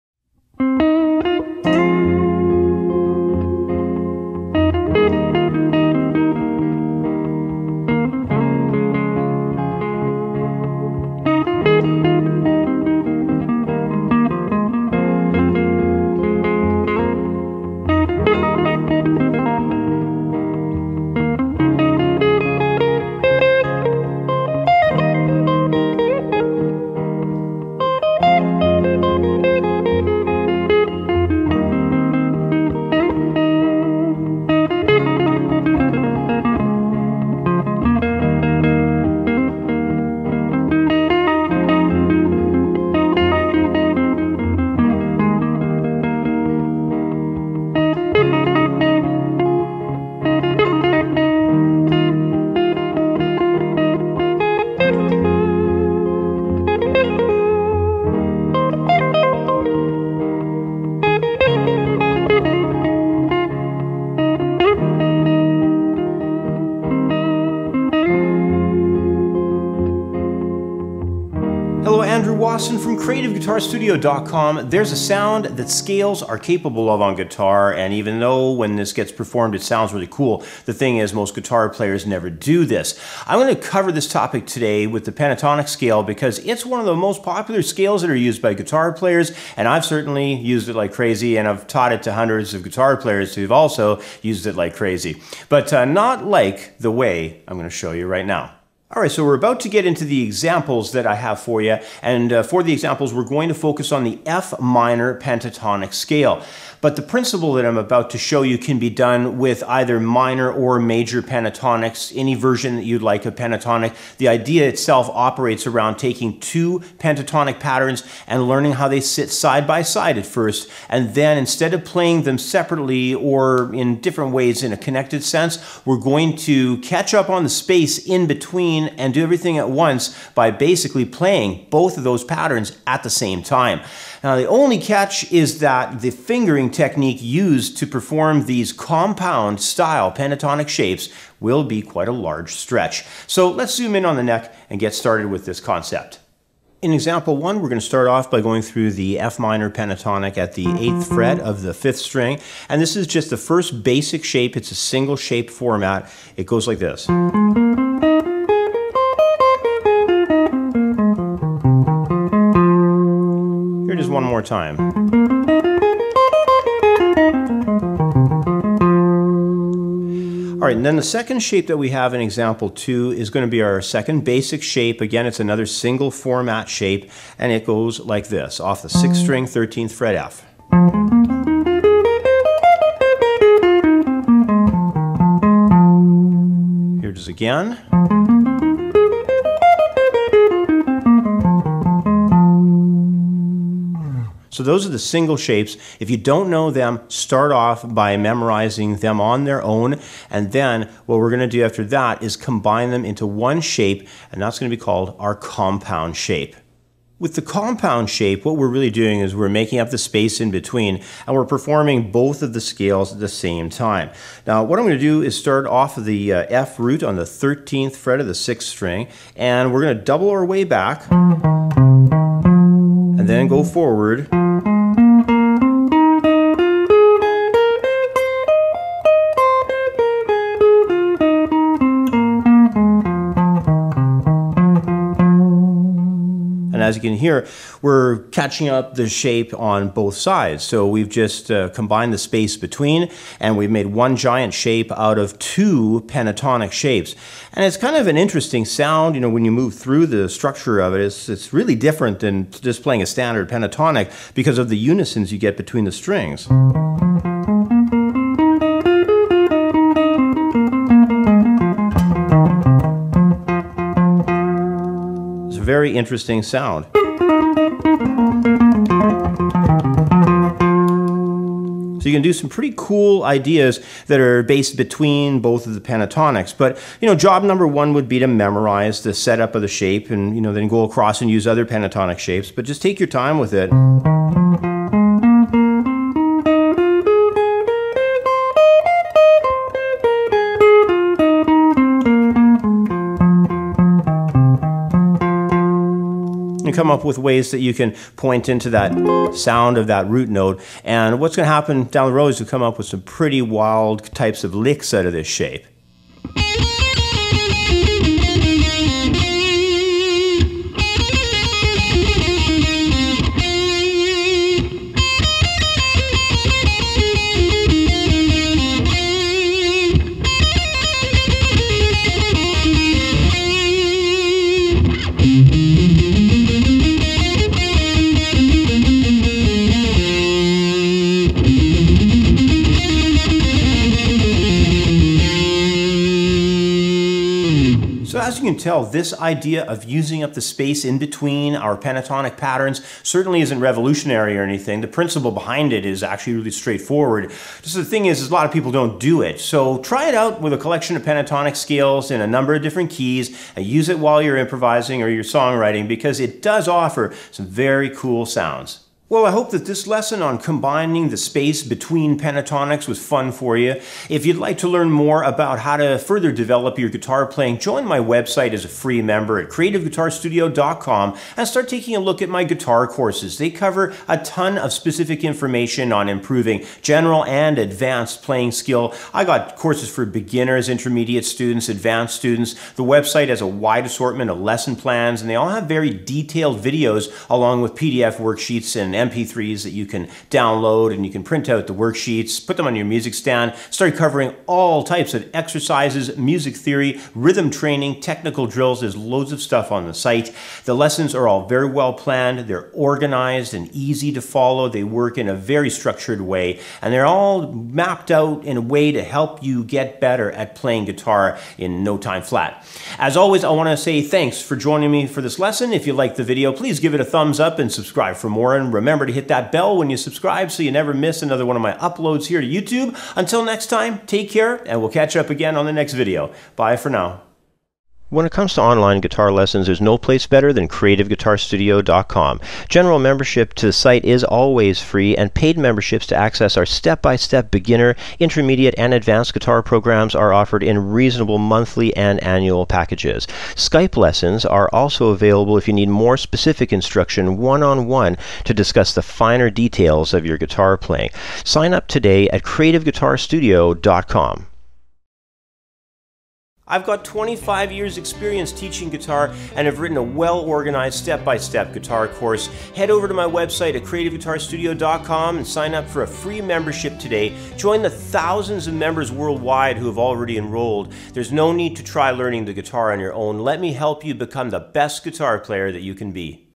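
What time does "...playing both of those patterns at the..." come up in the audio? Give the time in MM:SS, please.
02:11.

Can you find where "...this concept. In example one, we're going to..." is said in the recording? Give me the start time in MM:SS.
02:25.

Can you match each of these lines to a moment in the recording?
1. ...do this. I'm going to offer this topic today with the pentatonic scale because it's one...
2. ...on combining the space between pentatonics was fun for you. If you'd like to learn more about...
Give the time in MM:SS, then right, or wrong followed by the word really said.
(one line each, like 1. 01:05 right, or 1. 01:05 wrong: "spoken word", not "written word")
1. 01:22 wrong: "cover", not "offer"
2. 06:00 right.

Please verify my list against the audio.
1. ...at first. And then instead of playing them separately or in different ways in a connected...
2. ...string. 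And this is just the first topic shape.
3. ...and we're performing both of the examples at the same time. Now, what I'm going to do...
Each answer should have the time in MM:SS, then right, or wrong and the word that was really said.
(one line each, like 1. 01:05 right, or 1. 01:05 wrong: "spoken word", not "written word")
1. 02:00 right
2. 02:31 wrong: "basic", not "topic"
3. 03:31 wrong: "scales", not "examples".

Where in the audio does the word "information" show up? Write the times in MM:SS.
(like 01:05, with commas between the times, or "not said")
06:15.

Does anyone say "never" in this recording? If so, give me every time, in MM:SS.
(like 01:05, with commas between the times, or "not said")
01:22, 07:00.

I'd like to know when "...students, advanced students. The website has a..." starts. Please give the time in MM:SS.
06:21.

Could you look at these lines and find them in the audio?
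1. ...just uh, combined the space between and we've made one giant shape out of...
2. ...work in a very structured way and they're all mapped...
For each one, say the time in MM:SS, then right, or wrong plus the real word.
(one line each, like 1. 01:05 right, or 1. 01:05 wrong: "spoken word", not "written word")
1. 04:01 right
2. 06:44 right.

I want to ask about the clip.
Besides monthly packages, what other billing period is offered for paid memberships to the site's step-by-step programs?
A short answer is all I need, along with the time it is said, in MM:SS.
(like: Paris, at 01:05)
annual, at 07:22.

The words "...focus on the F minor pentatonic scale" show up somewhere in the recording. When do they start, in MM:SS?
01:43.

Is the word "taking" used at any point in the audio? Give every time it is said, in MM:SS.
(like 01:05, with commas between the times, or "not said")
01:55, 06:11.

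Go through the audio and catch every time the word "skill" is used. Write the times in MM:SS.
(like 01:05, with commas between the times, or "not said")
06:18.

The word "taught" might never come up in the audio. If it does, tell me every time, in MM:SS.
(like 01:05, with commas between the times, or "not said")
01:31.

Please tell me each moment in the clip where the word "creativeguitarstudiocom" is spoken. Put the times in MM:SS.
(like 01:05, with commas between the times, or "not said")
06:09, 07:10, 07:32, 07:43.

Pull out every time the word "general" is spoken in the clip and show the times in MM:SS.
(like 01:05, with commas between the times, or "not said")
06:16, 07:12.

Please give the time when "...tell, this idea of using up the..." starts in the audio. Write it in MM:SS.
05:38.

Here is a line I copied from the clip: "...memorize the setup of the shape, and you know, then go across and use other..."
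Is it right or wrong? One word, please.
right.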